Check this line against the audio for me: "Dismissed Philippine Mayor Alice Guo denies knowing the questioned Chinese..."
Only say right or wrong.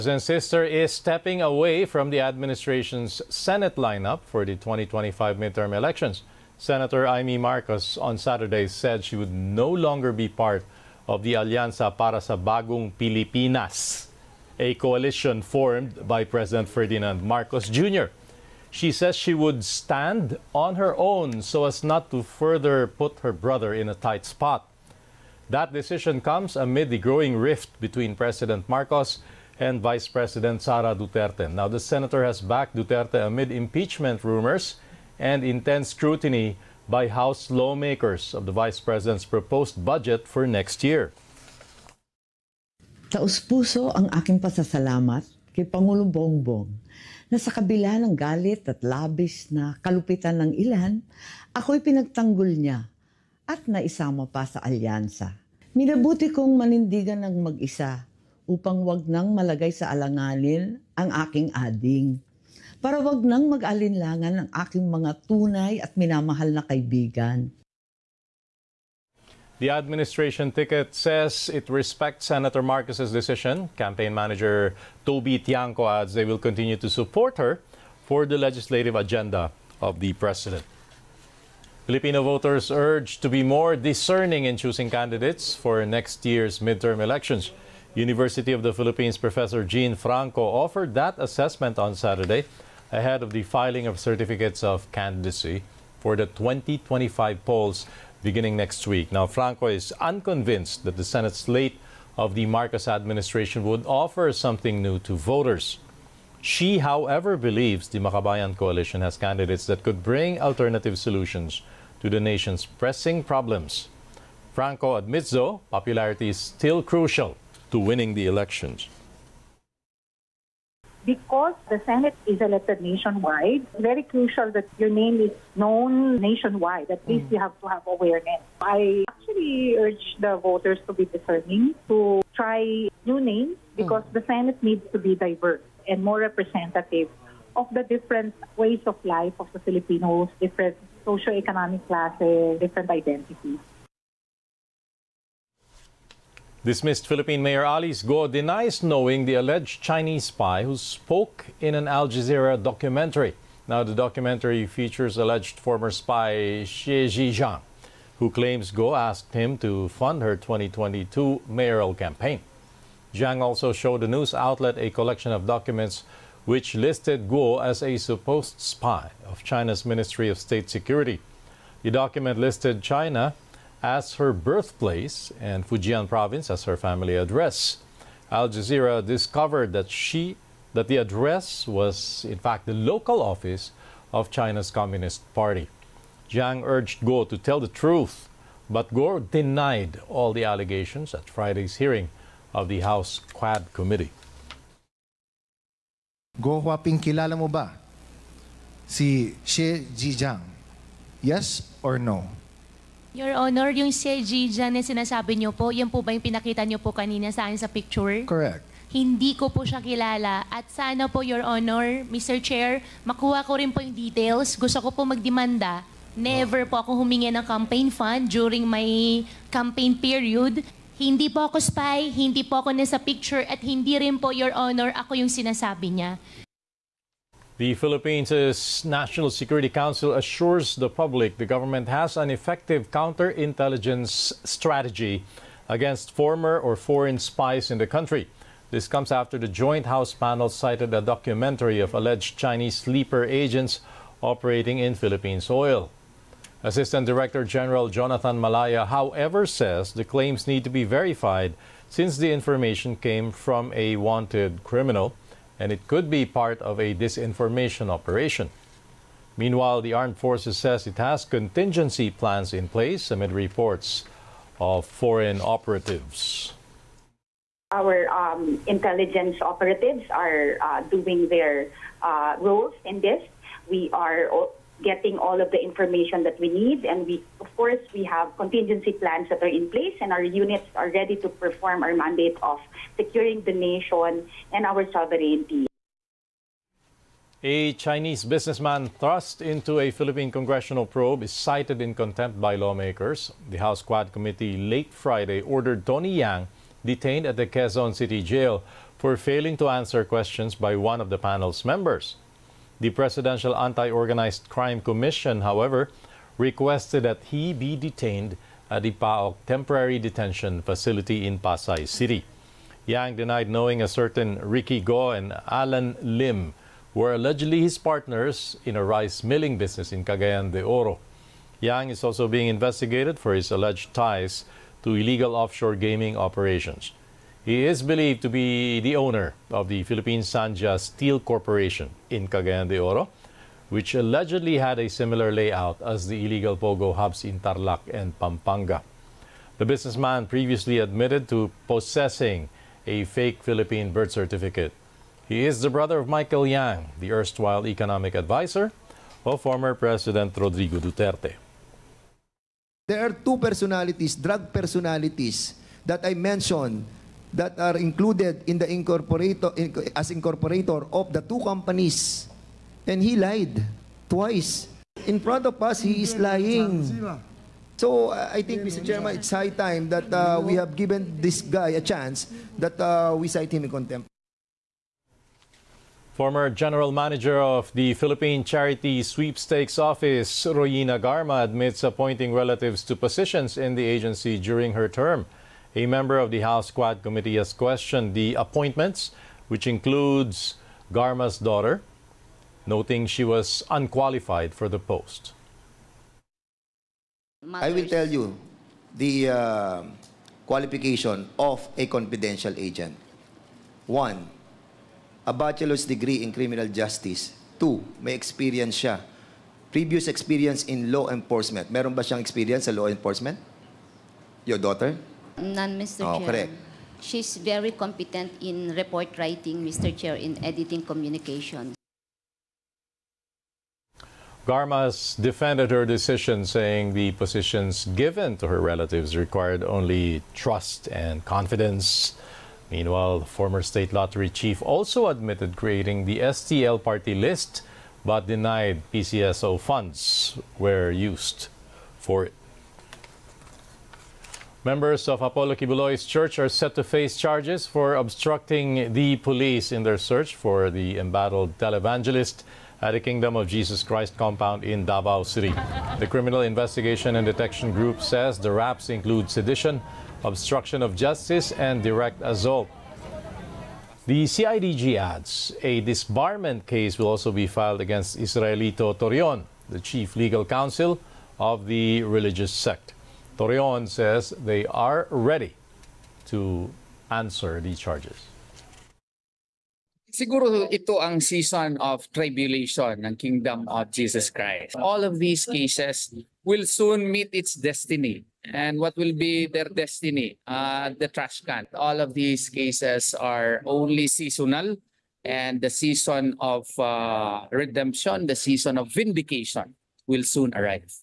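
wrong.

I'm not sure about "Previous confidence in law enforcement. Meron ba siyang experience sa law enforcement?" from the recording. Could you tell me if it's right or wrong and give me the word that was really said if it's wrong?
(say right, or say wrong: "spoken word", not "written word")
wrong: "experience", not "confidence".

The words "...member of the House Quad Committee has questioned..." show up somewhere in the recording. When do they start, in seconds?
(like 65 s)
385 s.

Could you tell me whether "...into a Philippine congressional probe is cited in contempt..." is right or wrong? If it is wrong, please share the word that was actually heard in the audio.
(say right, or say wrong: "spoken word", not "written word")
right.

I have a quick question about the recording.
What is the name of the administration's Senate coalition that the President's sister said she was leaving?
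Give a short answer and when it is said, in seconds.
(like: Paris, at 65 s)
Alianza para sa Bagong Pilipinas, at 11 s.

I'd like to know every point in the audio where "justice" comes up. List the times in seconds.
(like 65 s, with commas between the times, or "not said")
406 s, 460 s.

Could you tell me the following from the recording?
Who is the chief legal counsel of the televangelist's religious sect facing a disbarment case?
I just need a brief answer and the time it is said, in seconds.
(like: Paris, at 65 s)
Israelito Torreon, at 468 s.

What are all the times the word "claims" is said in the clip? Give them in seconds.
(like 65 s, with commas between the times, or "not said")
158 s, 250 s.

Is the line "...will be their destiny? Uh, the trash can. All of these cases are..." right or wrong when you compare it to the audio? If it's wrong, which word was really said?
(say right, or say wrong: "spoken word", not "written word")
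right.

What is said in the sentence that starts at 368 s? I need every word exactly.
Chairman, it's high time that uh, we have given this guy a chance that uh, we cite him in contempt.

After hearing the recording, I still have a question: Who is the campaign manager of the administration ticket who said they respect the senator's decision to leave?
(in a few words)
Toby Tianco.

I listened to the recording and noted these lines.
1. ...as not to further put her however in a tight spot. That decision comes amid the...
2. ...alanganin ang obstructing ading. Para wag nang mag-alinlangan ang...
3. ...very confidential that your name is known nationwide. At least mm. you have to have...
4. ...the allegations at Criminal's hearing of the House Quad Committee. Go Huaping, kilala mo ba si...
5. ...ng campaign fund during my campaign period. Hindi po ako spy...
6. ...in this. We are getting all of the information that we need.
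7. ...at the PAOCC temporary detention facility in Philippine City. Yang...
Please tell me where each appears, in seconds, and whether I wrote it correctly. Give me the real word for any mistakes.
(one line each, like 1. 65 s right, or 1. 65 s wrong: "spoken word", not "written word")
1. 21 s wrong: "brother", not "however"
2. 59 s wrong: "aking", not "obstructing"
3. 123 s wrong: "crucial", not "confidential"
4. 190 s wrong: "Friday", not "Criminal"
5. 217 s right
6. 272 s right
7. 308 s wrong: "Pasay", not "Philippine".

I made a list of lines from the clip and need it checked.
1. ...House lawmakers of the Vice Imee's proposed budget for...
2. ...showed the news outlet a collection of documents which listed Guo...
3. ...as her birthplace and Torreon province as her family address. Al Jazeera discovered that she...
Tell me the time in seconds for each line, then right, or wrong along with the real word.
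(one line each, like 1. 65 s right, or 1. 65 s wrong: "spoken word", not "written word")
1. 37 s wrong: "President", not "Imee"
2. 163 s right
3. 173 s wrong: "Fujian", not "Torreon".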